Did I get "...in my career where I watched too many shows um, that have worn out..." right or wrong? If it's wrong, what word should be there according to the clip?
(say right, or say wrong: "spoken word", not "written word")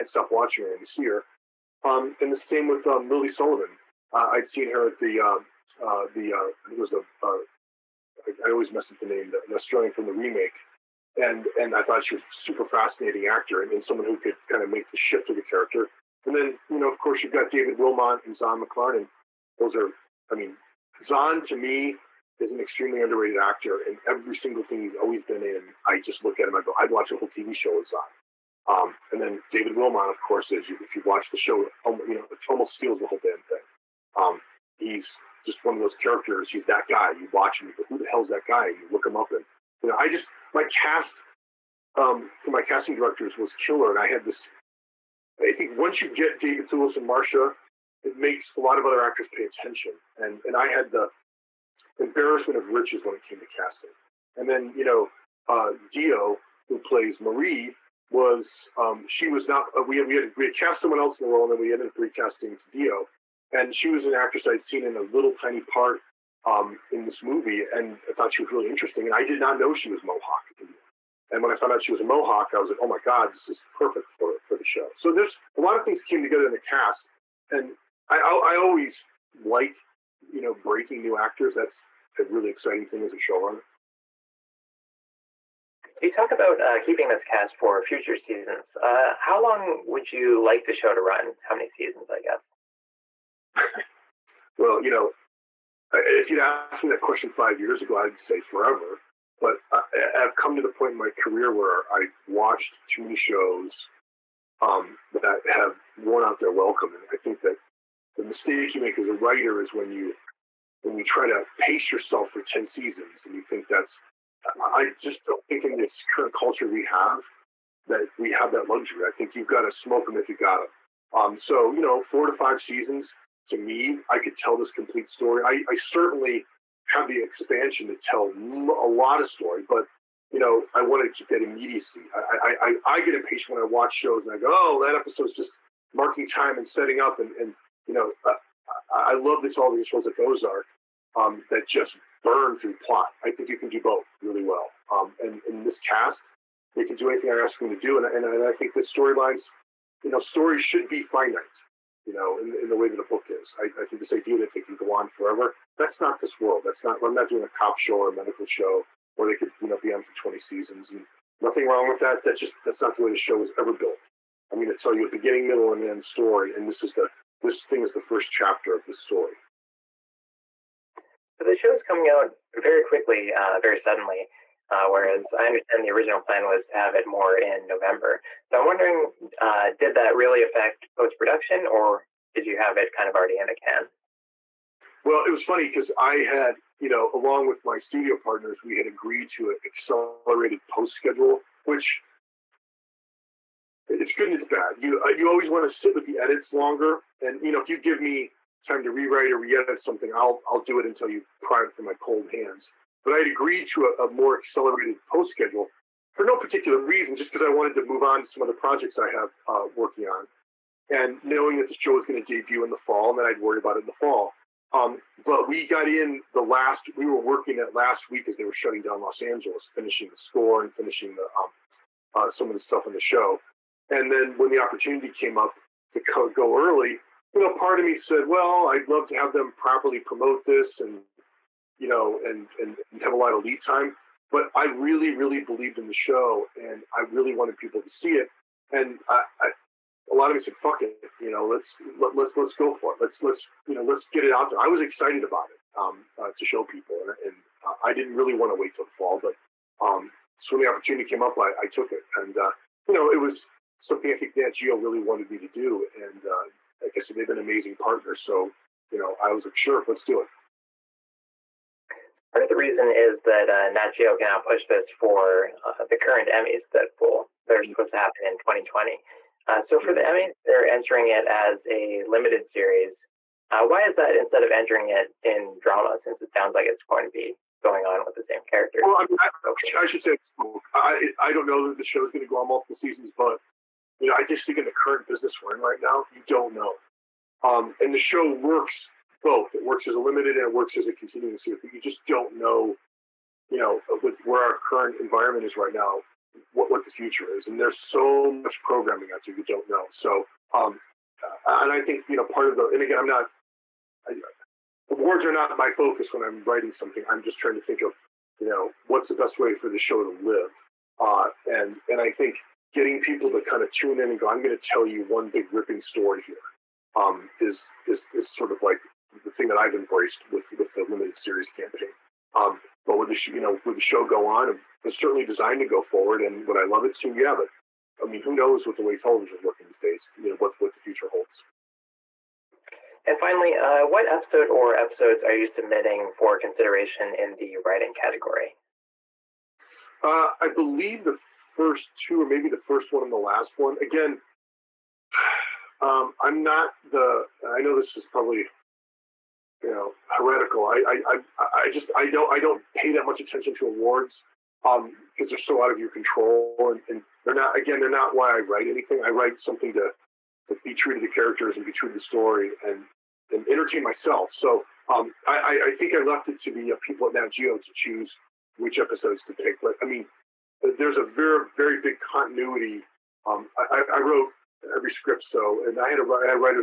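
right.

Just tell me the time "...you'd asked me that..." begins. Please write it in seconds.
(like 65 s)
96 s.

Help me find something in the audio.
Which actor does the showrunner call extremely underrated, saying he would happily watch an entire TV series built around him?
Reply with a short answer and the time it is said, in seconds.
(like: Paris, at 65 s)
Zahn McClarnon, at 18 s.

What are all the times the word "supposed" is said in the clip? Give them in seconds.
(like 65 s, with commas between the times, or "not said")
267 s.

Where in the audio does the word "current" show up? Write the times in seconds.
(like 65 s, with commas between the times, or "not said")
116 s, 265 s, 284 s, 294 s.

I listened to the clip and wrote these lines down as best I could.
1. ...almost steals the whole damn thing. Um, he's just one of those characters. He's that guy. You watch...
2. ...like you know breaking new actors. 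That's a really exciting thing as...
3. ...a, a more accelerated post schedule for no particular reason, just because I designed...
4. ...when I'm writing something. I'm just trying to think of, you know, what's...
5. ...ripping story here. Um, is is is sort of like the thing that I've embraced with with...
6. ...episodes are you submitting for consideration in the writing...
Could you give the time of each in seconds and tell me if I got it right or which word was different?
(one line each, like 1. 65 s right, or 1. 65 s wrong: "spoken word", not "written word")
1. 32 s right
2. 79 s right
3. 203 s wrong: "wanted", not "designed"
4. 306 s right
5. 315 s right
6. 334 s right.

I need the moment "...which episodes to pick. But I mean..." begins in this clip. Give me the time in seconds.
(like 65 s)
368 s.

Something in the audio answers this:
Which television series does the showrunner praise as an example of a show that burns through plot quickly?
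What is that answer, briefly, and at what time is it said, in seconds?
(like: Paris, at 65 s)
Ozark, at 140 s.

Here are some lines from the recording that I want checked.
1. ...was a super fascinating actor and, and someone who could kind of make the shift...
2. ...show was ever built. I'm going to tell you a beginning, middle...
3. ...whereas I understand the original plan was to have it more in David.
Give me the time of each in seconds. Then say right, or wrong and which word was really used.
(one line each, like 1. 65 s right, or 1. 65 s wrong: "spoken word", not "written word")
1. 12 s right
2. 163 s right
3. 174 s wrong: "November", not "David".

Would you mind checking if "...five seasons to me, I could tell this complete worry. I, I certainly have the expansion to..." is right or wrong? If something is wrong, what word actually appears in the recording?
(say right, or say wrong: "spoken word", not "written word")
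wrong: "story", not "worry".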